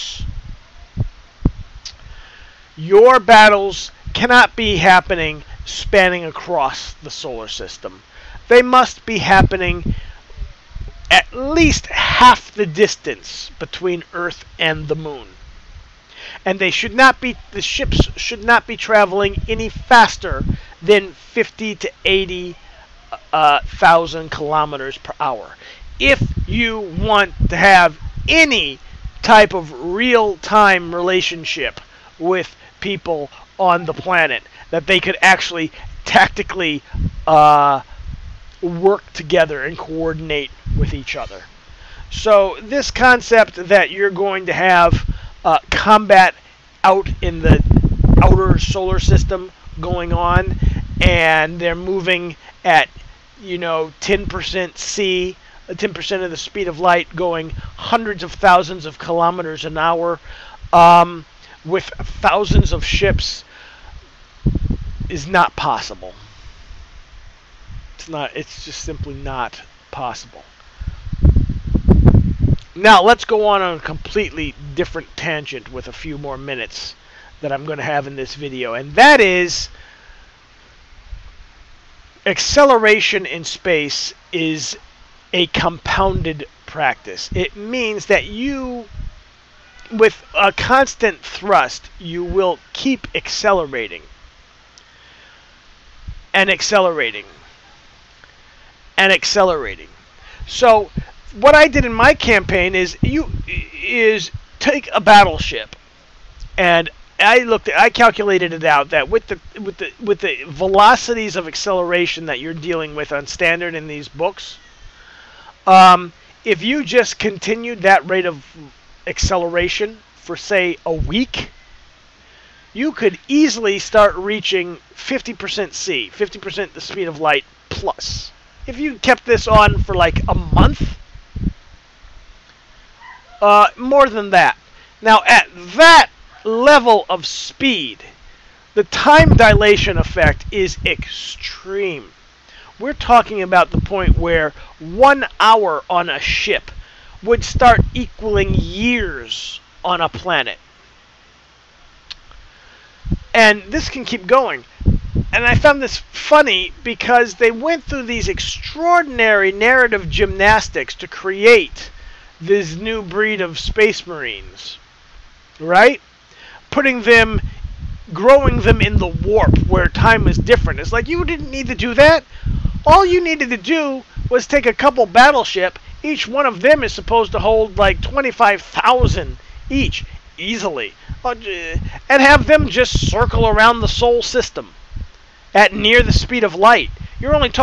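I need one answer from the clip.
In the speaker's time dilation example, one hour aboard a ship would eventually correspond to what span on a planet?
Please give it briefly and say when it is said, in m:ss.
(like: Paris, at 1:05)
years, at 2:28.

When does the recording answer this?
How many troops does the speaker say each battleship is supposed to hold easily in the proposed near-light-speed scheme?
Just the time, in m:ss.
2:58.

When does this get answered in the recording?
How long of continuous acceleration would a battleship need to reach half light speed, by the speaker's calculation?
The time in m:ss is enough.
2:00.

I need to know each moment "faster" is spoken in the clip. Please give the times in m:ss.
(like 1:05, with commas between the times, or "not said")
0:19.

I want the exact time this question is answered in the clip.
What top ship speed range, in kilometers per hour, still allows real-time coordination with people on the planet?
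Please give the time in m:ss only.
0:21.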